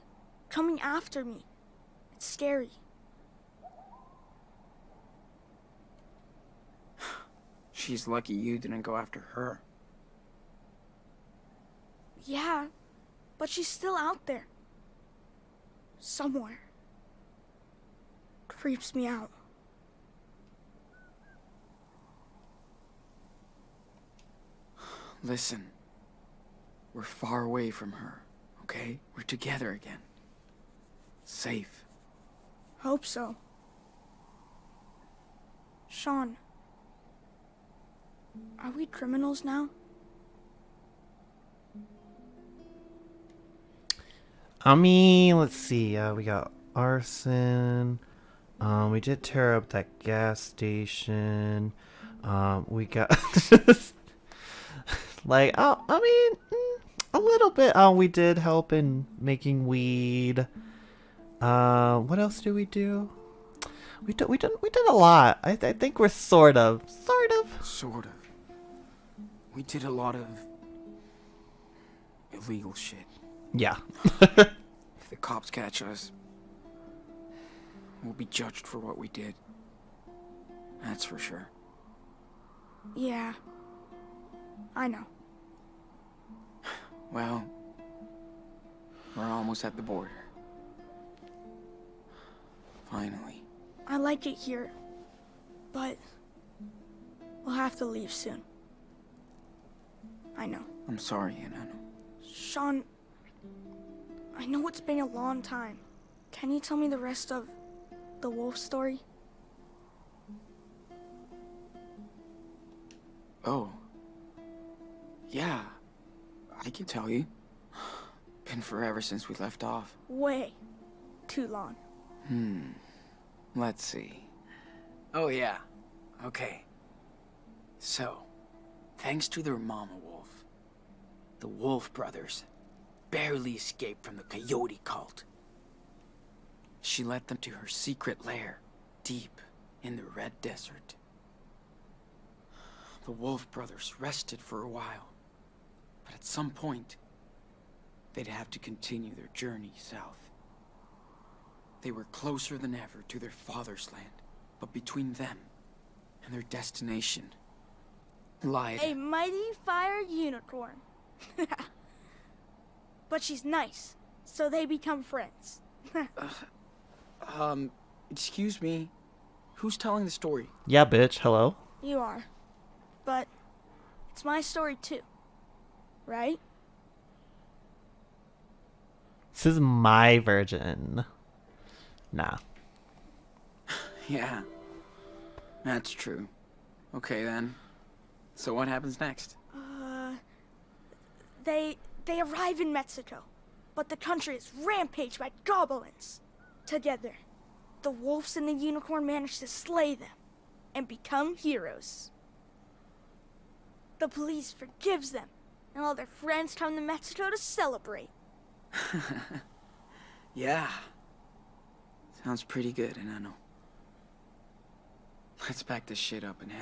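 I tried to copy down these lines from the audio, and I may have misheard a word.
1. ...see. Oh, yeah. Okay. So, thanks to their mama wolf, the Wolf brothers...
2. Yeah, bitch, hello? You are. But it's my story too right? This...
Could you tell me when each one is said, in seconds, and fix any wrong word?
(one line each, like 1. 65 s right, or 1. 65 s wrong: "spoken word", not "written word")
1. 123 s right
2. 170 s right.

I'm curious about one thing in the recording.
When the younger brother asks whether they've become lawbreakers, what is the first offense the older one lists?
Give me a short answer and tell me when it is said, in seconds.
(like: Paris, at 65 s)
Arson, at 46 s.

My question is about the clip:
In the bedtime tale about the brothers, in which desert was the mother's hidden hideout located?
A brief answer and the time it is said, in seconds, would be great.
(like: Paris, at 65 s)
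Red Desert, at 140 s.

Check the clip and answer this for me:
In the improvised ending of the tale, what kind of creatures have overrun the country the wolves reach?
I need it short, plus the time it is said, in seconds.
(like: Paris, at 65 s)
Goblins, at 195 s.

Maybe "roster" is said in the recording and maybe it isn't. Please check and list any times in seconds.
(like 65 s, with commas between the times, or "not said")
not said.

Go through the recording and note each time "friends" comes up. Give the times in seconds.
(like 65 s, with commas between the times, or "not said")
165 s, 206 s.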